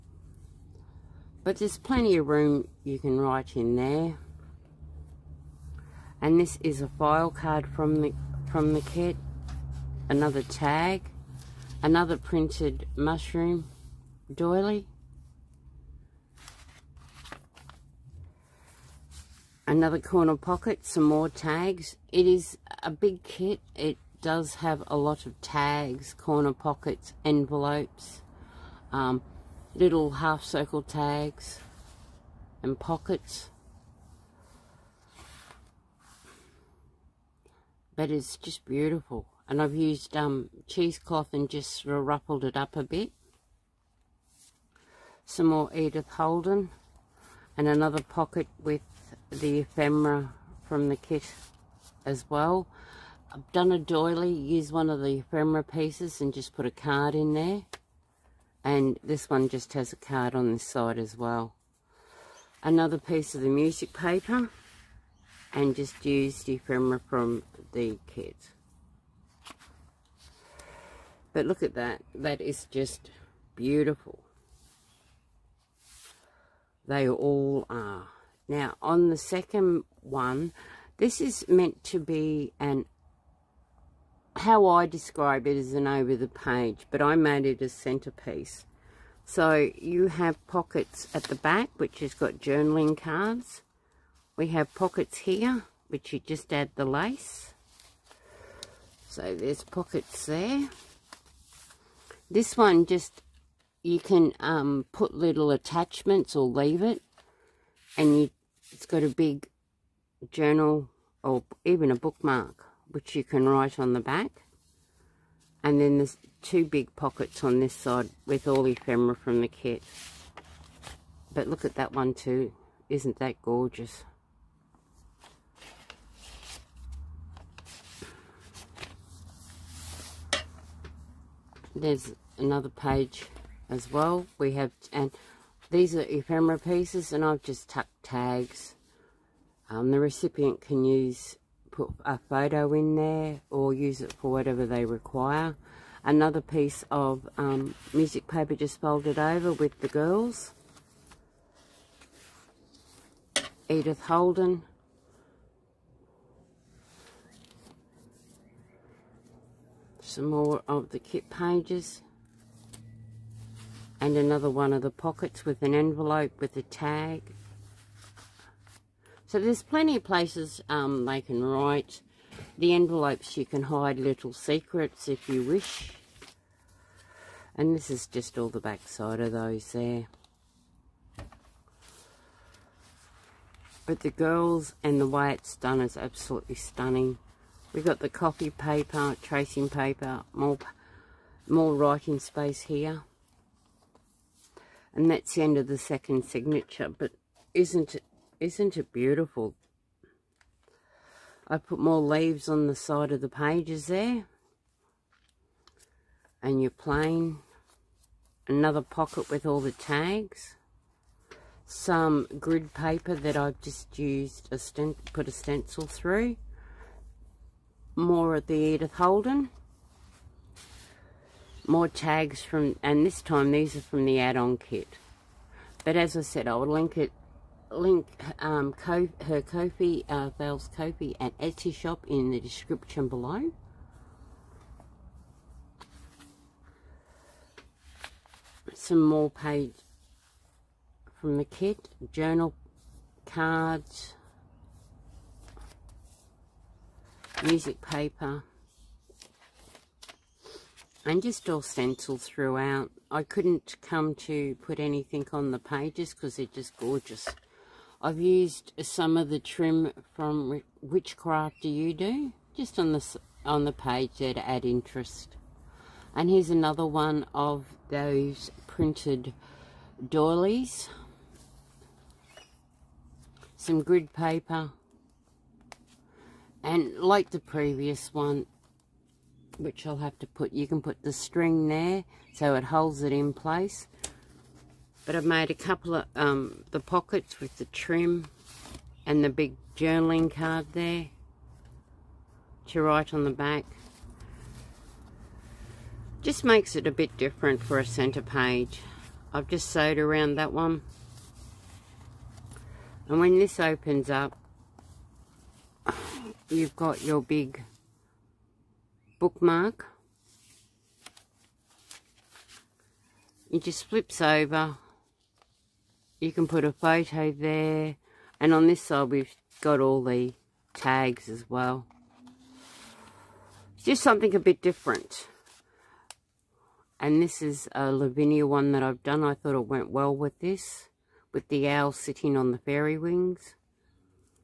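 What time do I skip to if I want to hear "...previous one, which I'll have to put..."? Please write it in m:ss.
4:37.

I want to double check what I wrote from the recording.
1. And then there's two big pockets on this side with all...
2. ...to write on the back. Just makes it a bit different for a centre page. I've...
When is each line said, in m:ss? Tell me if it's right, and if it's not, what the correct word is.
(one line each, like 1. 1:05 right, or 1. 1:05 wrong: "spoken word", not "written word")
1. 1:55 right
2. 4:52 right.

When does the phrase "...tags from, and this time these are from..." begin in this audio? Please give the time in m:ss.
3:41.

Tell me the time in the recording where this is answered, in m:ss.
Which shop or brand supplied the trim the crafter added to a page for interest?
4:20.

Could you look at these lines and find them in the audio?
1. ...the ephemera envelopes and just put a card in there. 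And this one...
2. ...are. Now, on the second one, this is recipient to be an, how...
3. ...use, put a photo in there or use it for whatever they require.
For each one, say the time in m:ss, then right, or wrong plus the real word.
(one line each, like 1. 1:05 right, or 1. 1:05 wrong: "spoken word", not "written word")
1. 0:55 wrong: "pieces", not "envelopes"
2. 1:17 wrong: "meant", not "recipient"
3. 2:20 right.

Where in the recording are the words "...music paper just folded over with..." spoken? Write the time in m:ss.
2:27.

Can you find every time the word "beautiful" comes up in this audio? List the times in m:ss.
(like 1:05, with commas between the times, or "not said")
0:38, 1:13, 3:18.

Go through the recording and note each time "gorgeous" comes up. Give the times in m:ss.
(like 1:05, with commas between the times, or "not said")
2:03, 4:16.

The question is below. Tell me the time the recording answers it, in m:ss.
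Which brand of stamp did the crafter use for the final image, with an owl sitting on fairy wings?
5:27.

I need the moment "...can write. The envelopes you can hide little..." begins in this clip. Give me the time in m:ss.
2:51.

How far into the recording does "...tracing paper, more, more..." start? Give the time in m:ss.
3:09.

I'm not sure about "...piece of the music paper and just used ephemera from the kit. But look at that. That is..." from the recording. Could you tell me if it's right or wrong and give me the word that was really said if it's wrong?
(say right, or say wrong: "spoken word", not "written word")
right.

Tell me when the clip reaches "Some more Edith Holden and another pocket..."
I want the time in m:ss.
0:45.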